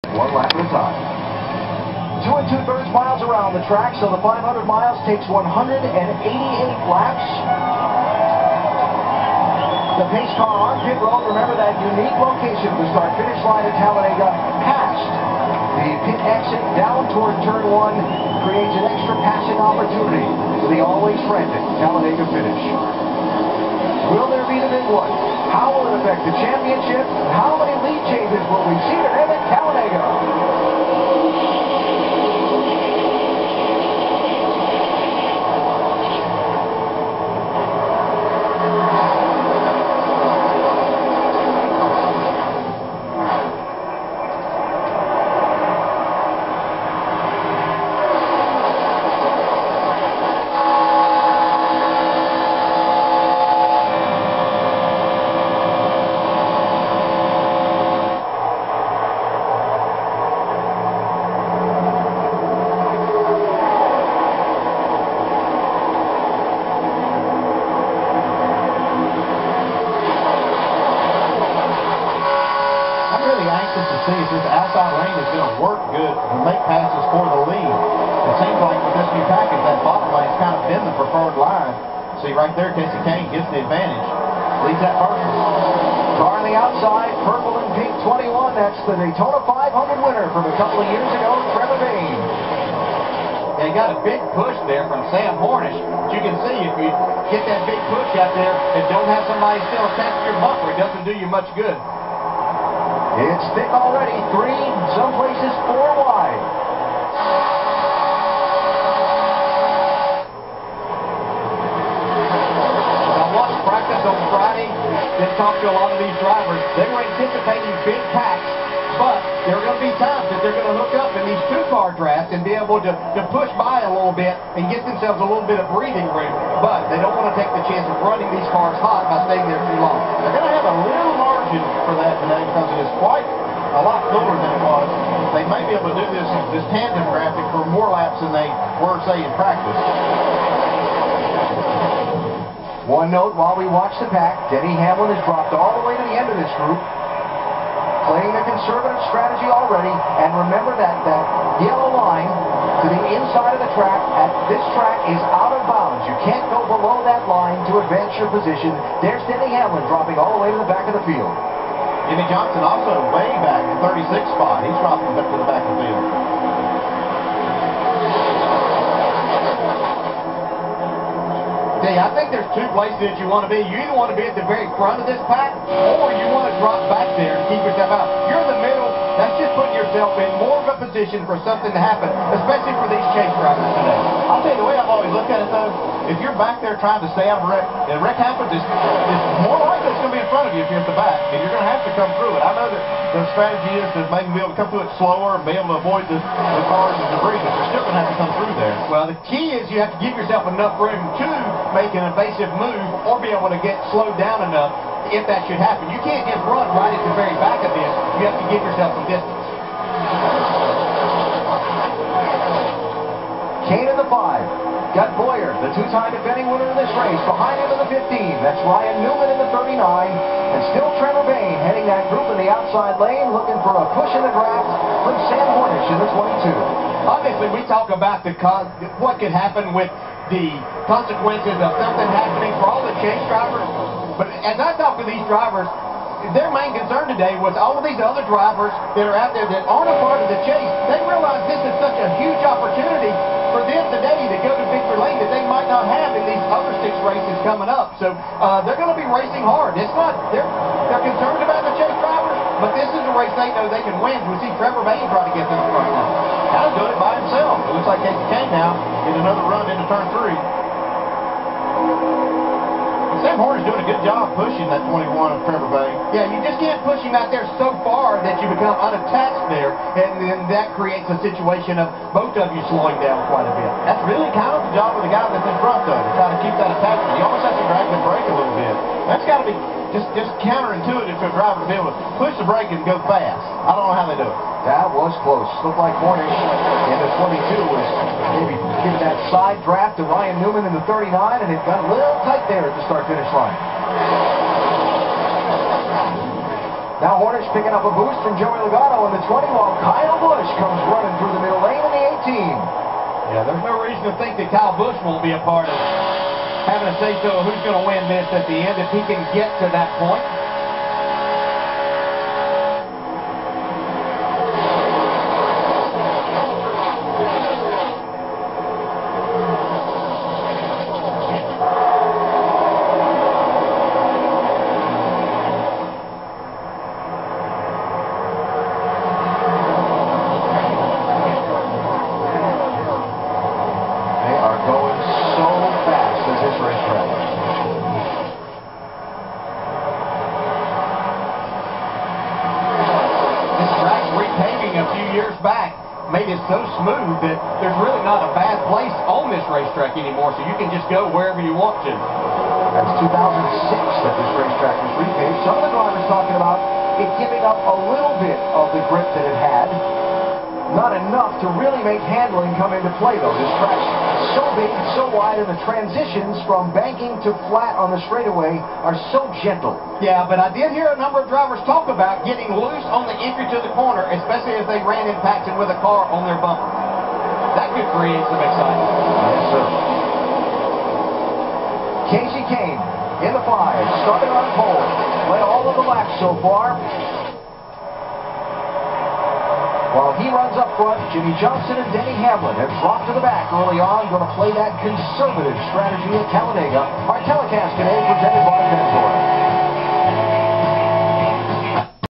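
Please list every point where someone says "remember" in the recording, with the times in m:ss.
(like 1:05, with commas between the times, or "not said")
0:11, 2:30.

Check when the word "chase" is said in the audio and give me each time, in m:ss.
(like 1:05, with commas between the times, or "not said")
3:03, 3:52, 4:00, 4:11.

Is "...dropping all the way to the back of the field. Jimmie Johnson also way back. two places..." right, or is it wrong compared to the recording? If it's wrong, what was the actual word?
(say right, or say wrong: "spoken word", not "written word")
right.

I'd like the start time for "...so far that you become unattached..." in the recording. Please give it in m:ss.
4:27.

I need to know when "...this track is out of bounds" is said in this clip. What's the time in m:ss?
2:34.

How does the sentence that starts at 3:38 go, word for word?
That's Ryan Newman in the 39.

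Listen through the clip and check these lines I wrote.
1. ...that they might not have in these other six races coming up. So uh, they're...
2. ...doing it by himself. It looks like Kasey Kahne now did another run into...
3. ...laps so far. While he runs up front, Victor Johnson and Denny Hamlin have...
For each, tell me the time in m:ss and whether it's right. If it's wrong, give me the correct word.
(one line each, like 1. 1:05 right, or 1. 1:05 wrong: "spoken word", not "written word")
1. 4:05 right
2. 4:16 right
3. 6:25 wrong: "Jimmie", not "Victor".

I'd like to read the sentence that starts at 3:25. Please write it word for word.
You can't just run right at the very back of this.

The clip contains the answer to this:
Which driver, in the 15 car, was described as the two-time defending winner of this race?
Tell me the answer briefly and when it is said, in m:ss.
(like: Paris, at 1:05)
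Bowyer, at 3:35.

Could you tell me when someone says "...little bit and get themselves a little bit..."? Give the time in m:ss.
2:03.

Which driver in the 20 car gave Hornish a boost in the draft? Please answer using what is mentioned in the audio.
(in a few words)
Joey Logano.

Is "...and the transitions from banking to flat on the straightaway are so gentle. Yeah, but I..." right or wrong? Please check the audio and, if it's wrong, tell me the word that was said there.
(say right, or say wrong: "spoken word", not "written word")
right.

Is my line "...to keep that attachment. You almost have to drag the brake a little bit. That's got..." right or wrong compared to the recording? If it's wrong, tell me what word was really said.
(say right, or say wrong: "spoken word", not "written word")
right.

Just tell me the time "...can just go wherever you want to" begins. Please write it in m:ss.
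5:50.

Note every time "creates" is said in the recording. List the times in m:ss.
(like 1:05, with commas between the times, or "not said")
0:18, 4:30, 6:17.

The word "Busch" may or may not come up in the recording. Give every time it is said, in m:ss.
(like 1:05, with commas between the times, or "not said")
5:00, 5:04.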